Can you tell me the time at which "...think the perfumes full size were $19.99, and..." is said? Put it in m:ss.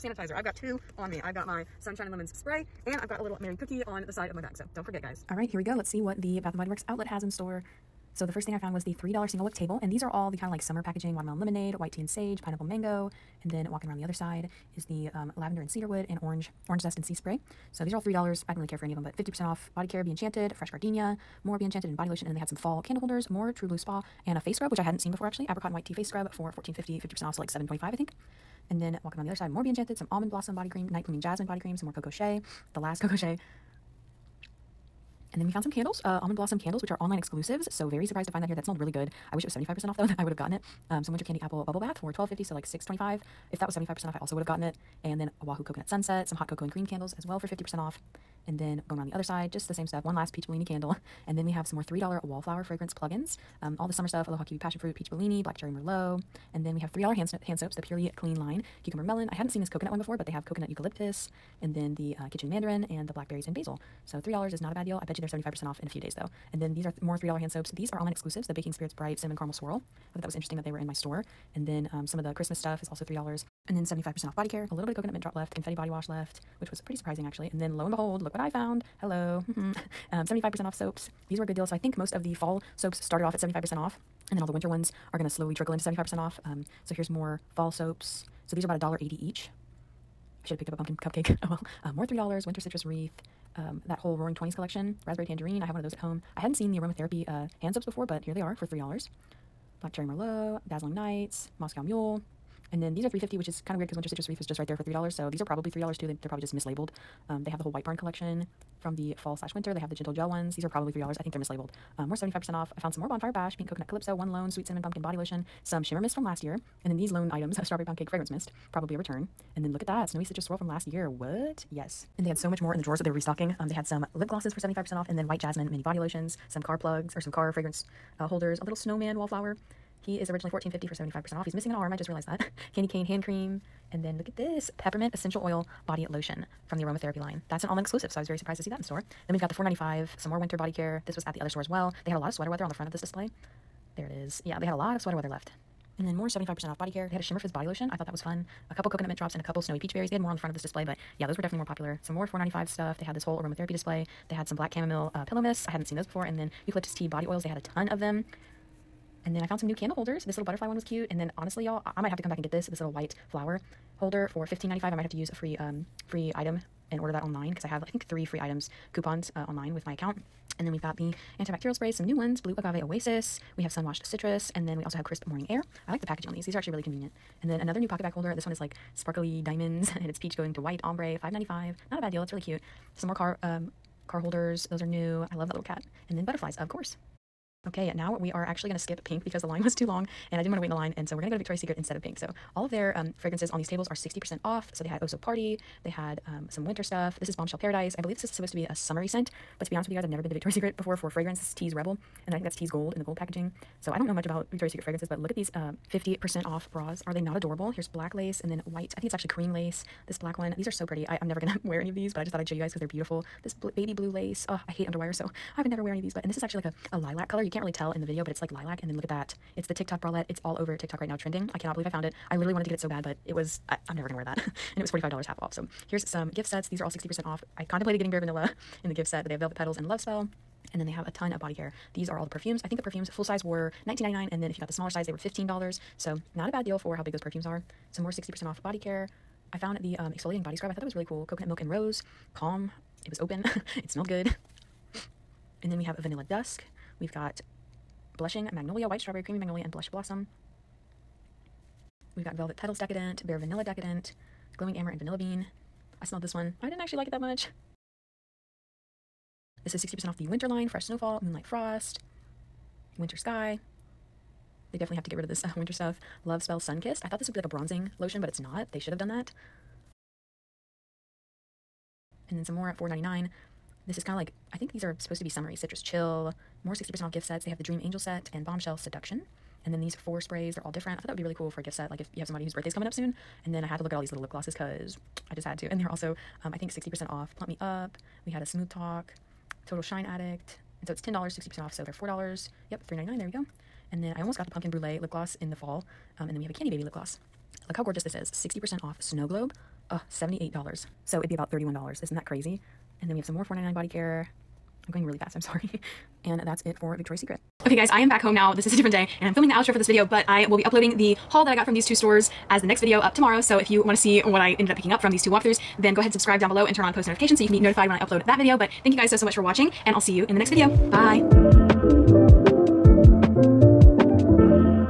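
3:52.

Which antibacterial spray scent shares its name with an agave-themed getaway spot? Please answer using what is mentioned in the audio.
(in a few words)
Blue Agave Oasis.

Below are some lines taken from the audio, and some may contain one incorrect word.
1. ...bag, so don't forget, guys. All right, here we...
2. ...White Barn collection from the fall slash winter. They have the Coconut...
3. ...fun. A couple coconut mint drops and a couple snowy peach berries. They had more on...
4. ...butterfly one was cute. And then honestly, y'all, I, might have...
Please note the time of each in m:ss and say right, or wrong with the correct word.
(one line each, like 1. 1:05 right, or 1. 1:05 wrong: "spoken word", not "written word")
1. 0:04 right
2. 1:47 wrong: "Gentle", not "Coconut"
3. 2:28 right
4. 2:40 right.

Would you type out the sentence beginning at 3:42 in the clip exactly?
I literally wanted to get it so bad, but it was I, I'm never going to wear that.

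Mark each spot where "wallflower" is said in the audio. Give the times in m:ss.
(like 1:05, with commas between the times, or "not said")
0:52, 2:09.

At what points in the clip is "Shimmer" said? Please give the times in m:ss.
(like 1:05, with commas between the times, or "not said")
1:55, 2:27.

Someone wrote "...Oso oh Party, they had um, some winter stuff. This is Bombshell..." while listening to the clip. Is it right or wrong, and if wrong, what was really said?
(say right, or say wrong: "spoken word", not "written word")
right.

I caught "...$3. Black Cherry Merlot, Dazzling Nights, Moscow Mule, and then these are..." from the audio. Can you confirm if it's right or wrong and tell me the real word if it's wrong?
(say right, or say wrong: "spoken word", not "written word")
right.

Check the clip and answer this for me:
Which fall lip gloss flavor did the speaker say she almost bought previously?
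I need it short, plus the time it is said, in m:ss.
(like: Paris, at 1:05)
pumpkin brulee, at 4:54.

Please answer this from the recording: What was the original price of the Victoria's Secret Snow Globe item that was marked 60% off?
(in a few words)
$78.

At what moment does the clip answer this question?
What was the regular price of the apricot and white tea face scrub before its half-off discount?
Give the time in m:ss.
0:26.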